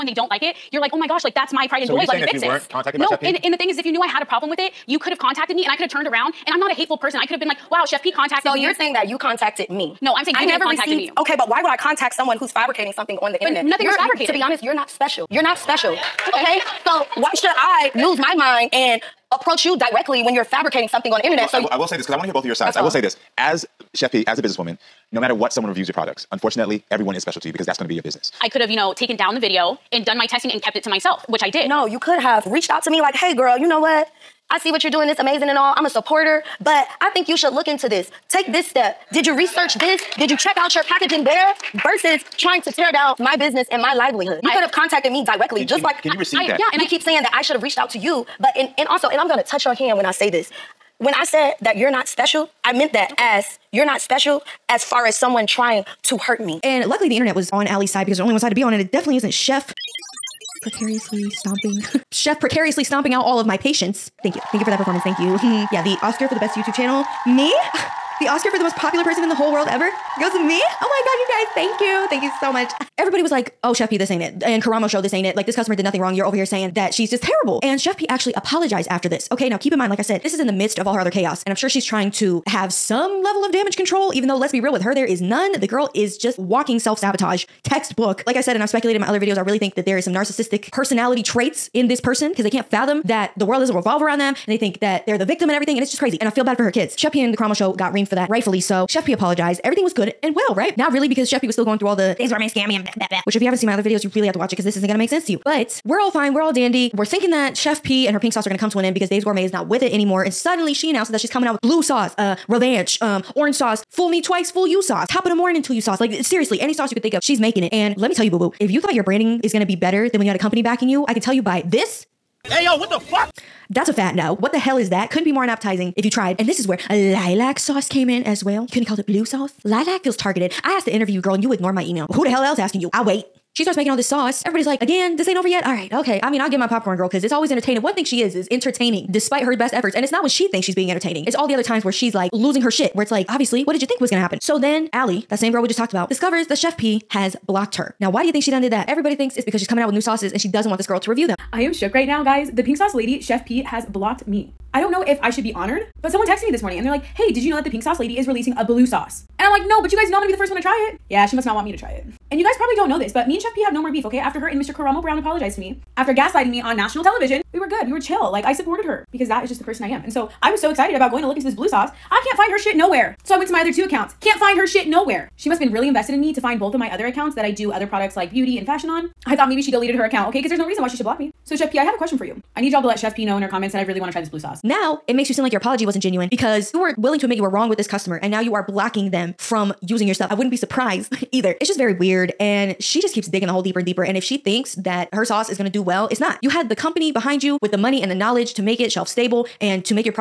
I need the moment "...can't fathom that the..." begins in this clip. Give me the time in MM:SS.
01:32.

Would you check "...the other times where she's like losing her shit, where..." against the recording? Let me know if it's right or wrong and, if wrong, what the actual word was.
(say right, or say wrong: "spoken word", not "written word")
right.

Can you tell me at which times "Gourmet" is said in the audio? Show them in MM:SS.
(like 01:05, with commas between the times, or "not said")
01:42, 01:49.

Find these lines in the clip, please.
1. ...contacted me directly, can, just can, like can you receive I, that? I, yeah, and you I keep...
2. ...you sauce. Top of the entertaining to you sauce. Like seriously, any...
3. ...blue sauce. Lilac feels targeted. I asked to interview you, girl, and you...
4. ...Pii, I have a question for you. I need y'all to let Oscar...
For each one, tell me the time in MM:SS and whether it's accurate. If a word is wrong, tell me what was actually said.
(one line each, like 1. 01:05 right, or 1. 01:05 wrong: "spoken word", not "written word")
1. 00:44 right
2. 01:54 wrong: "morning", not "entertaining"
3. 02:09 right
4. 03:01 wrong: "Chef", not "Oscar".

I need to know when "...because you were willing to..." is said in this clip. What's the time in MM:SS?
03:06.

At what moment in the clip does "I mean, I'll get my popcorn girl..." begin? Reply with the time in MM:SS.
02:16.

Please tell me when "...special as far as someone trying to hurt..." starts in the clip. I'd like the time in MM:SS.
00:53.